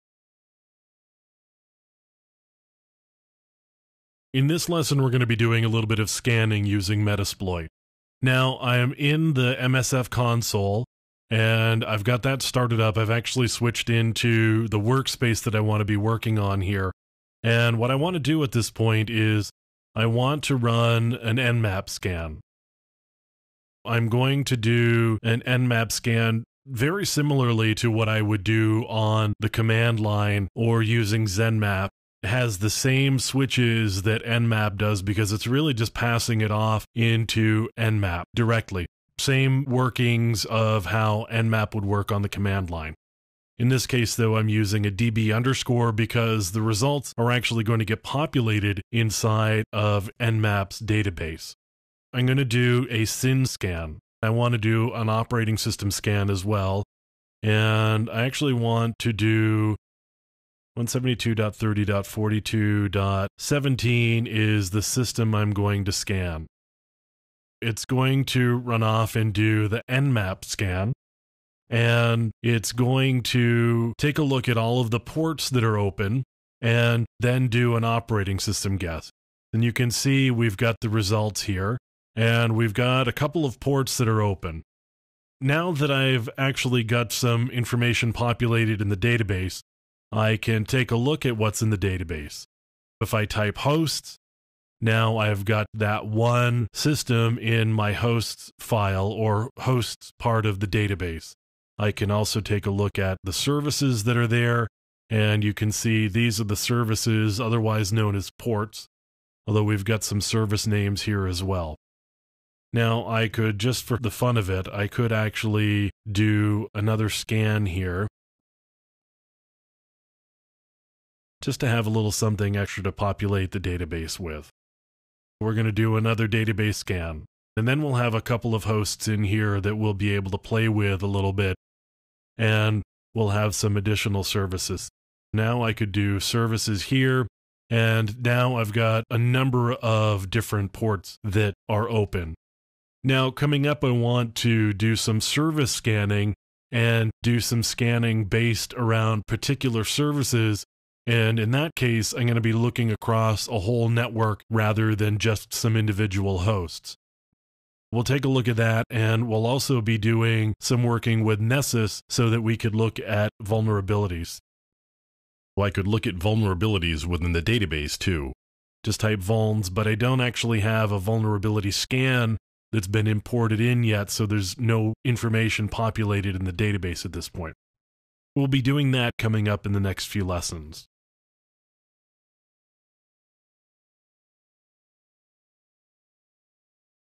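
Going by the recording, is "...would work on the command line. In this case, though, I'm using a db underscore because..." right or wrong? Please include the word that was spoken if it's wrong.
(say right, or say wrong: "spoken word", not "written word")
right.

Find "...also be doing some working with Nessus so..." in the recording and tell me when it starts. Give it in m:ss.
2:39.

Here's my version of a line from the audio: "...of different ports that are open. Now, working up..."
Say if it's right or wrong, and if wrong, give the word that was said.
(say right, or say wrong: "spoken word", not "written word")
wrong: "coming", not "working".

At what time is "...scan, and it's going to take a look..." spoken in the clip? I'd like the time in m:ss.
1:10.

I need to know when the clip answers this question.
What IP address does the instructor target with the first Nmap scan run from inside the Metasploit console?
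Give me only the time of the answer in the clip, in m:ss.
1:00.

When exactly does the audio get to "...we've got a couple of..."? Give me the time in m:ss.
1:22.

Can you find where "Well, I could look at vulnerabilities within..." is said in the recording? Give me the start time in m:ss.
2:45.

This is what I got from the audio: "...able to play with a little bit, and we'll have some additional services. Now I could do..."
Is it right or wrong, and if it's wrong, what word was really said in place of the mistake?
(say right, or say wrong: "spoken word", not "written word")
right.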